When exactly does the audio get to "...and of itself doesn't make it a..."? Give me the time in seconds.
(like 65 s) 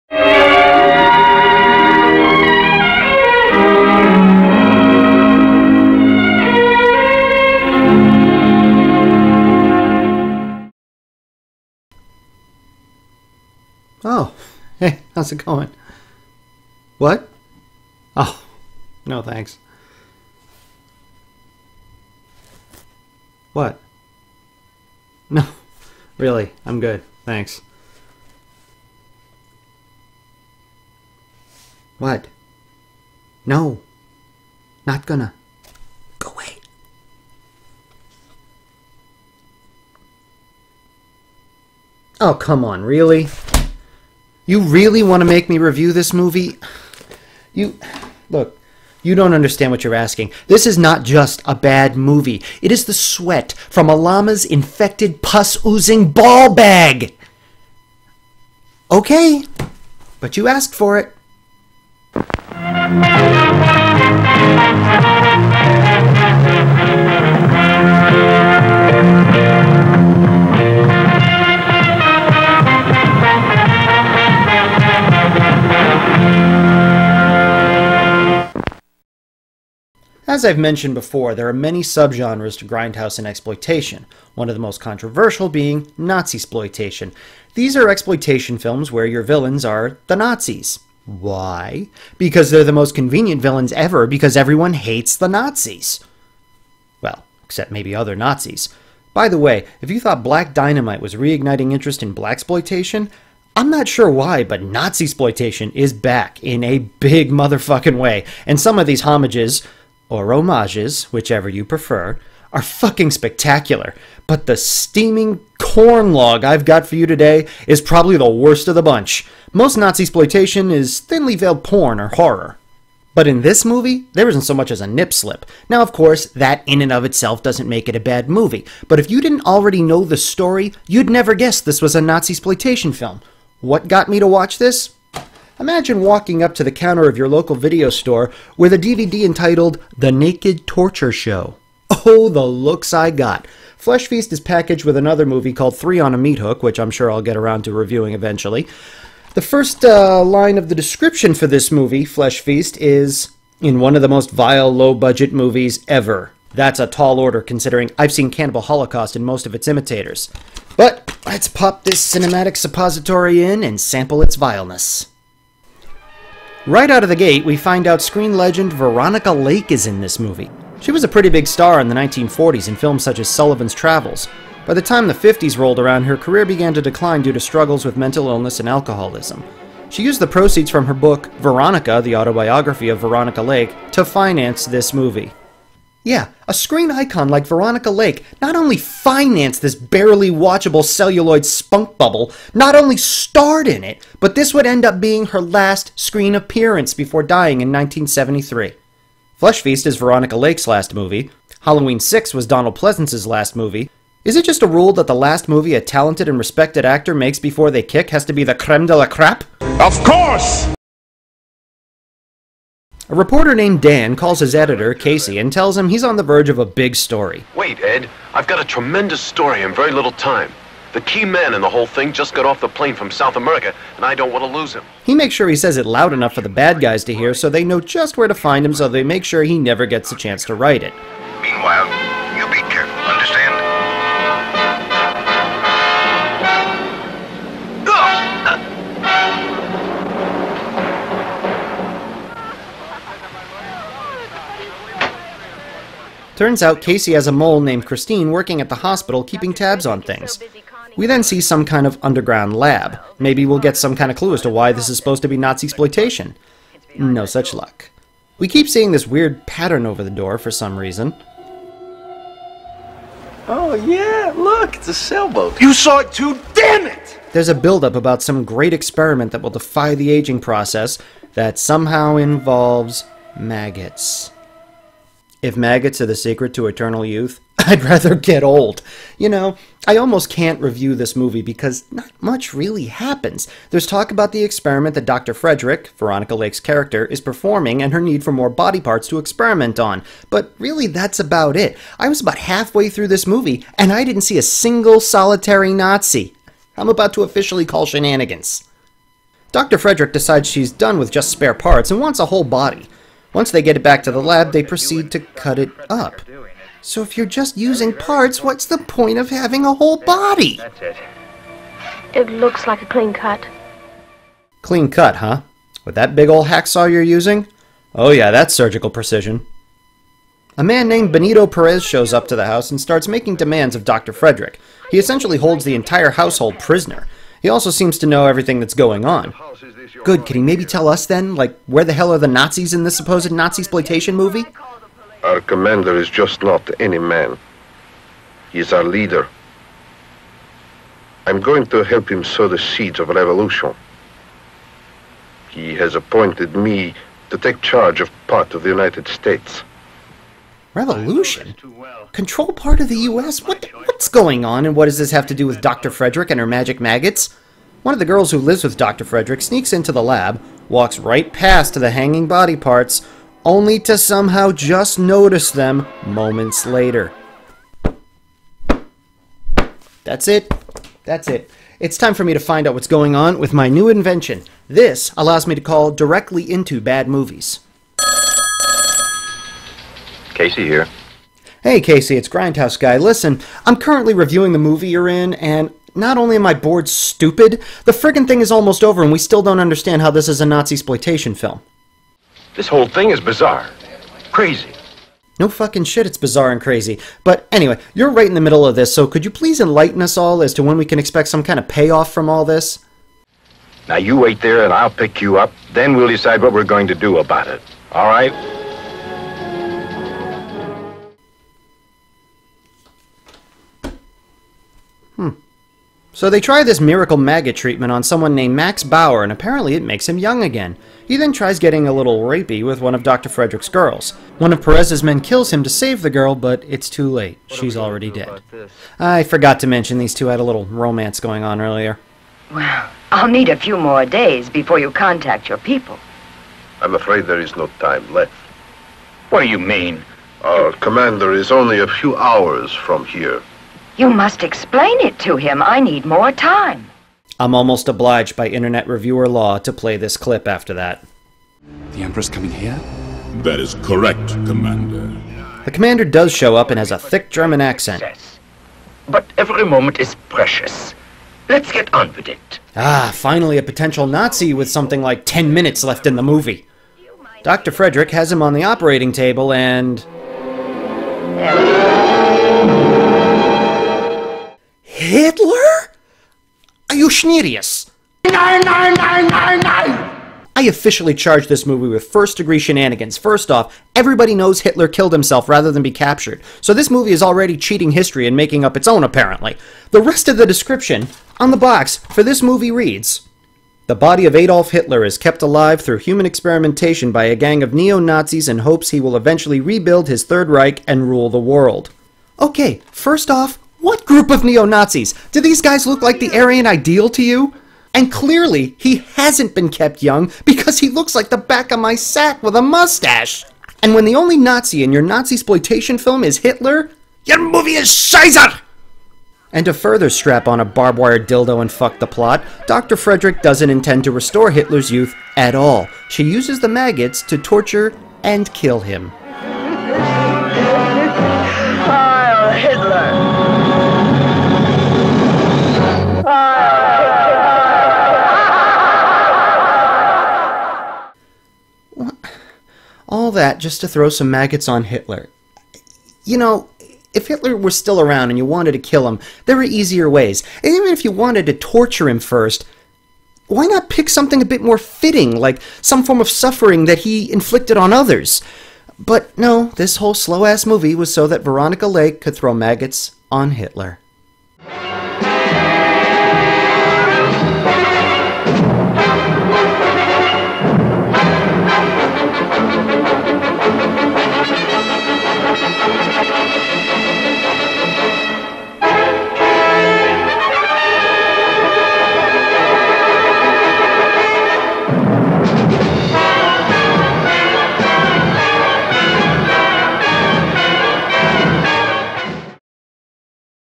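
126 s.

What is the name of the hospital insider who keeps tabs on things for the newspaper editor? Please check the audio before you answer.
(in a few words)
Christine.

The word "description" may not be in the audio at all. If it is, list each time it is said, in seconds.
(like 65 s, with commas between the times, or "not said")
150 s, 490 s.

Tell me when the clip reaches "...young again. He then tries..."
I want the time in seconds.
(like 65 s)
420 s.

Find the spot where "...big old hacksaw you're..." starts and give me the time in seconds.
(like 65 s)
316 s.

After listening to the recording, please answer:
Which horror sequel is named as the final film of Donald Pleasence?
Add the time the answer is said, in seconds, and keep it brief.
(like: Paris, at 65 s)
Halloween 6, at 201 s.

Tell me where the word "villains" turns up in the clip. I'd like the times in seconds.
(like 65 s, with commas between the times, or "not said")
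89 s, 93 s.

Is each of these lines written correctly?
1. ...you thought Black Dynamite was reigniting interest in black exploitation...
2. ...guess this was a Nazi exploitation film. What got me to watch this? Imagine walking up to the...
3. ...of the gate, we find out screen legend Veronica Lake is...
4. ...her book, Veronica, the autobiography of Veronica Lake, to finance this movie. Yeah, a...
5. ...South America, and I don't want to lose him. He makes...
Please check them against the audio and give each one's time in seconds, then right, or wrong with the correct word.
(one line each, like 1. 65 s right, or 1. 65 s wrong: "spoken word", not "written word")
1. 99 s right
2. 131 s right
3. 167 s right
4. 180 s right
5. 223 s right.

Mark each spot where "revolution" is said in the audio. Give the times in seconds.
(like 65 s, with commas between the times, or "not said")
343 s, 350 s.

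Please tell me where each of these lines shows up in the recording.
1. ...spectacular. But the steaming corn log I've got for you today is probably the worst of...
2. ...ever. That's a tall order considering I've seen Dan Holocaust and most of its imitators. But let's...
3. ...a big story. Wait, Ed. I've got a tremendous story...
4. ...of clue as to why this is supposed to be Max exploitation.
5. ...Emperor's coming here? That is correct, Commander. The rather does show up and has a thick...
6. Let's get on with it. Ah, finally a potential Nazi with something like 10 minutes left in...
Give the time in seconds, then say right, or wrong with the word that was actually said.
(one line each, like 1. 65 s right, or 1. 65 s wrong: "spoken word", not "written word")
1. 113 s right
2. 155 s wrong: "Cannibal", not "Dan"
3. 216 s right
4. 254 s wrong: "Nazi", not "Max"
5. 452 s wrong: "commander", not "rather"
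6. 461 s right.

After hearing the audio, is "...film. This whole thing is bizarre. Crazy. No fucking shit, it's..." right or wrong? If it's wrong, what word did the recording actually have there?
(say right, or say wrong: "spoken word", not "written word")
right.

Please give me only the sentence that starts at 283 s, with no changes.
There's talk about the experiment that Dr.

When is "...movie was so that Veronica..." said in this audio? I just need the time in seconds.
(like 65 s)
560 s.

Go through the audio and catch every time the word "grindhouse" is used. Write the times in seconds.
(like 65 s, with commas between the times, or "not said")
82 s, 382 s.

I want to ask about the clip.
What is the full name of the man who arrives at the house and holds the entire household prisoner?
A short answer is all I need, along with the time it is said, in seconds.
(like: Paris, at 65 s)
Benito Perez, at 321 s.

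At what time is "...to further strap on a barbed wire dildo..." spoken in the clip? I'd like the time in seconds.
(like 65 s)
519 s.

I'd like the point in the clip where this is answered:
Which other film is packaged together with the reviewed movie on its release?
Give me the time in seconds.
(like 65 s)
145 s.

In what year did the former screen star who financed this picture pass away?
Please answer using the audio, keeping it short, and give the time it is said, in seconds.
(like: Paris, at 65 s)
1973, at 197 s.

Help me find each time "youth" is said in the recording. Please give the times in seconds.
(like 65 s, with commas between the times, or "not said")
277 s, 524 s.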